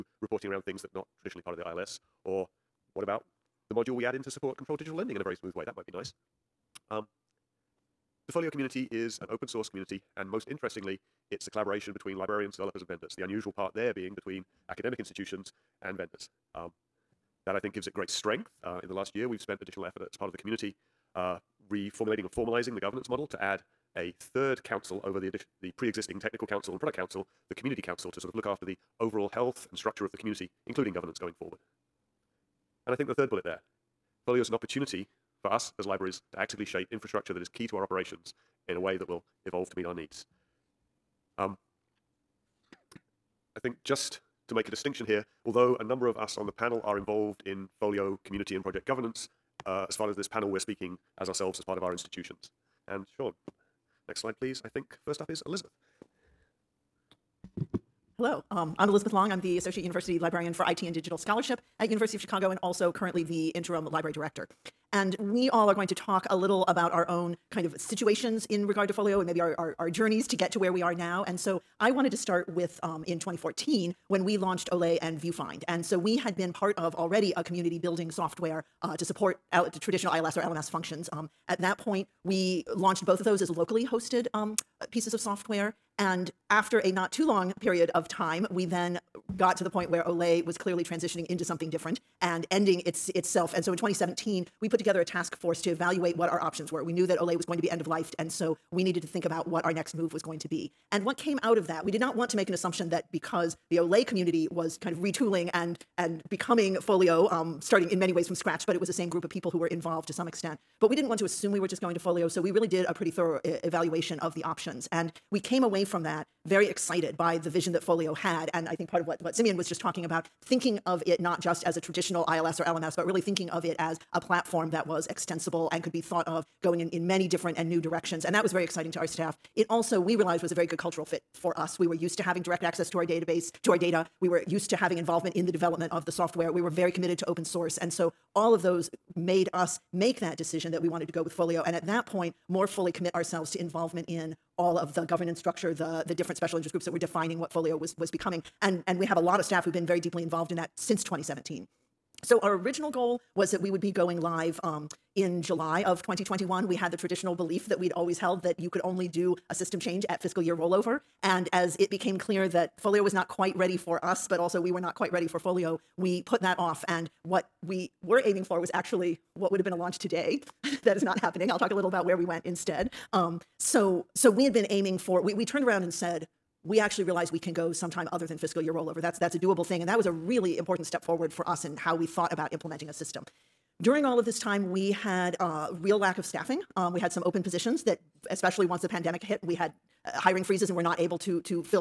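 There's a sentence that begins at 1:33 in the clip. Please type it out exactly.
And so in 2017, we put together a task force to evaluate what our options were.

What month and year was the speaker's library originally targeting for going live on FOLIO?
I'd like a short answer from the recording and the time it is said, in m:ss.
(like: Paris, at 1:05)
July 2021, at 2:35.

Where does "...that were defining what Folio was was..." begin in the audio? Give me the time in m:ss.
2:26.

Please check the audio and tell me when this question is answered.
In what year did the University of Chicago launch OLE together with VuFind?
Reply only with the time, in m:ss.
1:13.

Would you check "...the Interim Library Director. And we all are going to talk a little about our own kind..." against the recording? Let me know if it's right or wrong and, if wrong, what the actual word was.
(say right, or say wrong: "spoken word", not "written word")
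right.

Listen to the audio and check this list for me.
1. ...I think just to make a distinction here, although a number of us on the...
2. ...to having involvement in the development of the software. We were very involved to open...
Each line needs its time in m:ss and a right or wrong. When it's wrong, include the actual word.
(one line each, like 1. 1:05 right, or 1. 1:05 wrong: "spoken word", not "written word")
1. 0:43 right
2. 2:14 wrong: "committed", not "involved".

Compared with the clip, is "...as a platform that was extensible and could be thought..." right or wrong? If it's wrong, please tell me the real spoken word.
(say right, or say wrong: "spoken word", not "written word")
right.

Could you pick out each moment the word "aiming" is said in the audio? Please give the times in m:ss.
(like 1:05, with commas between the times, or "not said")
2:48, 2:54.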